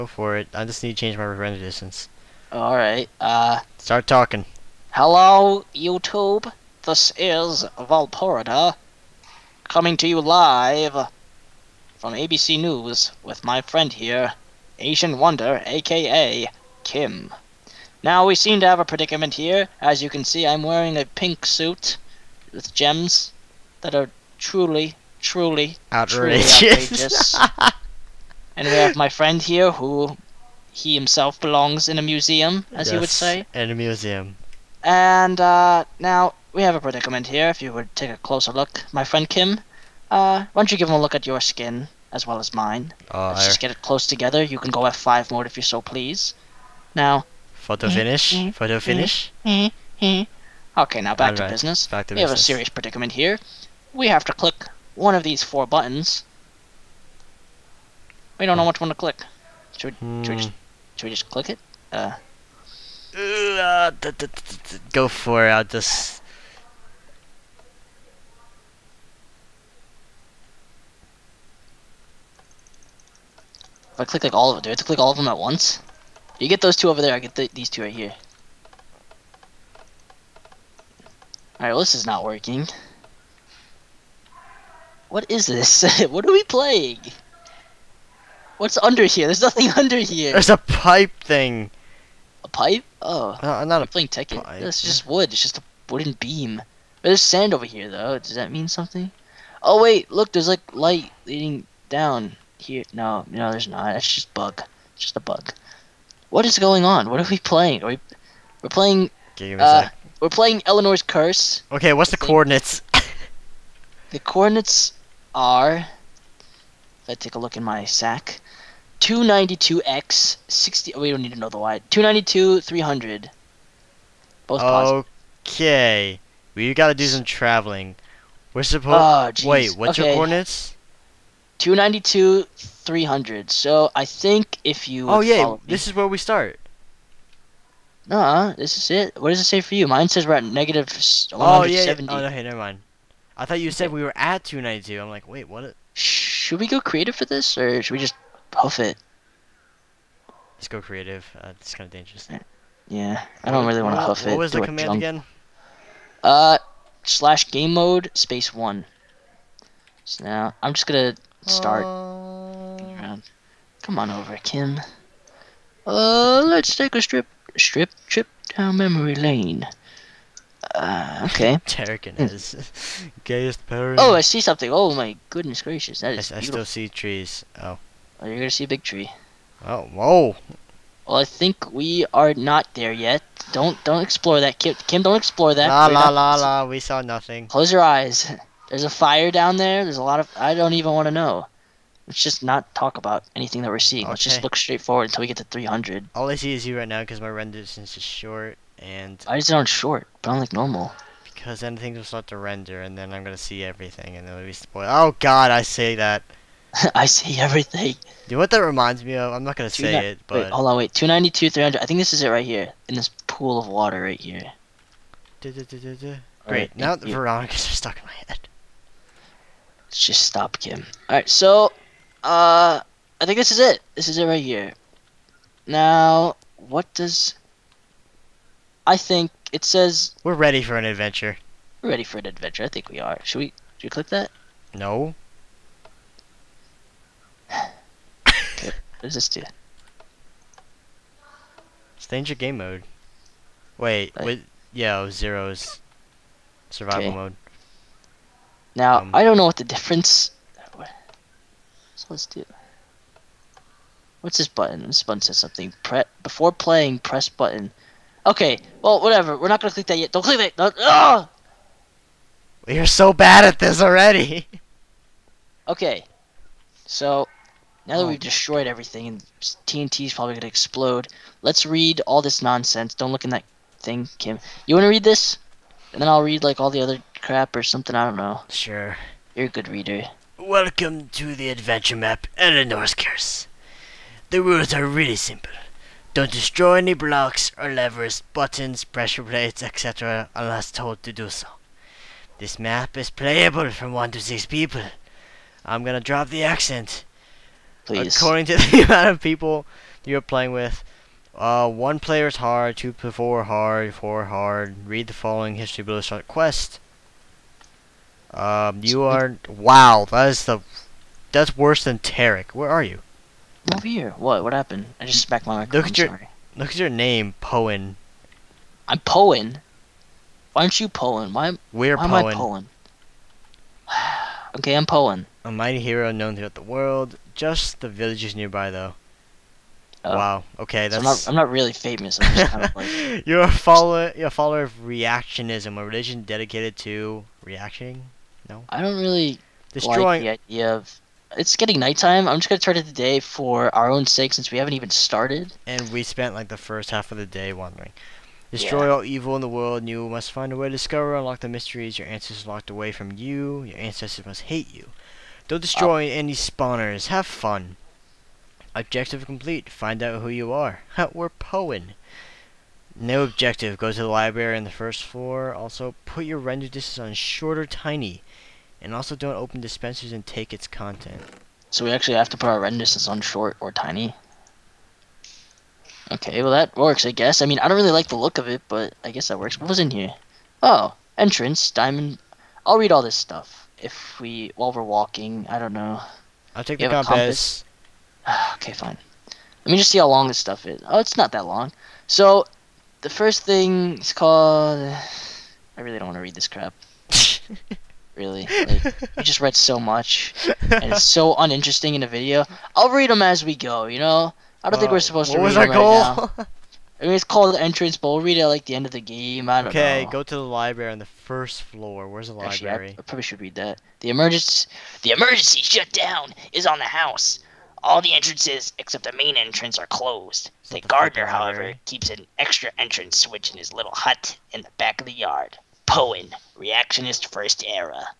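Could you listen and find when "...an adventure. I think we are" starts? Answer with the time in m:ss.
3:52.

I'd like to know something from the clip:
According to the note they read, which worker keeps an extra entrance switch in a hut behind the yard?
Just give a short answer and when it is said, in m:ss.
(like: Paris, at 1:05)
The gardener, at 7:00.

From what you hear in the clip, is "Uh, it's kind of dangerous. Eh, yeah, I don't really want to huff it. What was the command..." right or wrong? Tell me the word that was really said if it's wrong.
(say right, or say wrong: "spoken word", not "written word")
right.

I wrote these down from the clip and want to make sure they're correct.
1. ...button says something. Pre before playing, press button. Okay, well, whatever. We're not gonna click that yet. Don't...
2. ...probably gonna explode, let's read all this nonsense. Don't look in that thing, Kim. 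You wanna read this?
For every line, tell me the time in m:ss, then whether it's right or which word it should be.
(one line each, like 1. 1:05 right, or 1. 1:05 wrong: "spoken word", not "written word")
1. 4:15 right
2. 4:30 right.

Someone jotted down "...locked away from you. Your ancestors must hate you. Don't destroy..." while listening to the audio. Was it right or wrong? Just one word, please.
right.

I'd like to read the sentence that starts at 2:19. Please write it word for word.
Mine says we're at negative 170.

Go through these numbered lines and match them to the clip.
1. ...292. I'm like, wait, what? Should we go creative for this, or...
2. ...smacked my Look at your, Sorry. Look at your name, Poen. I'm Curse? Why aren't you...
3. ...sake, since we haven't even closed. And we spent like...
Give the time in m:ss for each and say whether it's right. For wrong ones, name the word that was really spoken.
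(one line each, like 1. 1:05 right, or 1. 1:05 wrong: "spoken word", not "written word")
1. 2:24 right
2. 5:15 wrong: "Poen", not "Curse"
3. 5:44 wrong: "started", not "closed".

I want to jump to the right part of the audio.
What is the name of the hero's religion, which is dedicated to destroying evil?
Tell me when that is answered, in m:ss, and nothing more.
5:34.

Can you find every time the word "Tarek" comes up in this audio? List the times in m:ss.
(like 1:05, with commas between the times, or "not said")
2:51, 5:11.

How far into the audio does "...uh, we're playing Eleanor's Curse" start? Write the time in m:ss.
1:49.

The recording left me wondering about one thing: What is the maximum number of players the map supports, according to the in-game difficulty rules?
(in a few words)
6.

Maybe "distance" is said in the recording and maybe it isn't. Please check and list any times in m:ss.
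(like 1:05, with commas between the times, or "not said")
0:01, 3:17, 6:06, 6:12.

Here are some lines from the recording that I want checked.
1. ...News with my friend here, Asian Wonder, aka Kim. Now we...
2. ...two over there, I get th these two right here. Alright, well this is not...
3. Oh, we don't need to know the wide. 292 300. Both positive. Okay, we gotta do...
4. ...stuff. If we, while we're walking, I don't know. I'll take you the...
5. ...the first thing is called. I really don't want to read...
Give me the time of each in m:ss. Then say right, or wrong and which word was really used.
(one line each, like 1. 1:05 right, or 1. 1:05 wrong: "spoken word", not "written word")
1. 0:12 right
2. 1:16 right
3. 2:00 right
4. 6:23 right
5. 6:33 right.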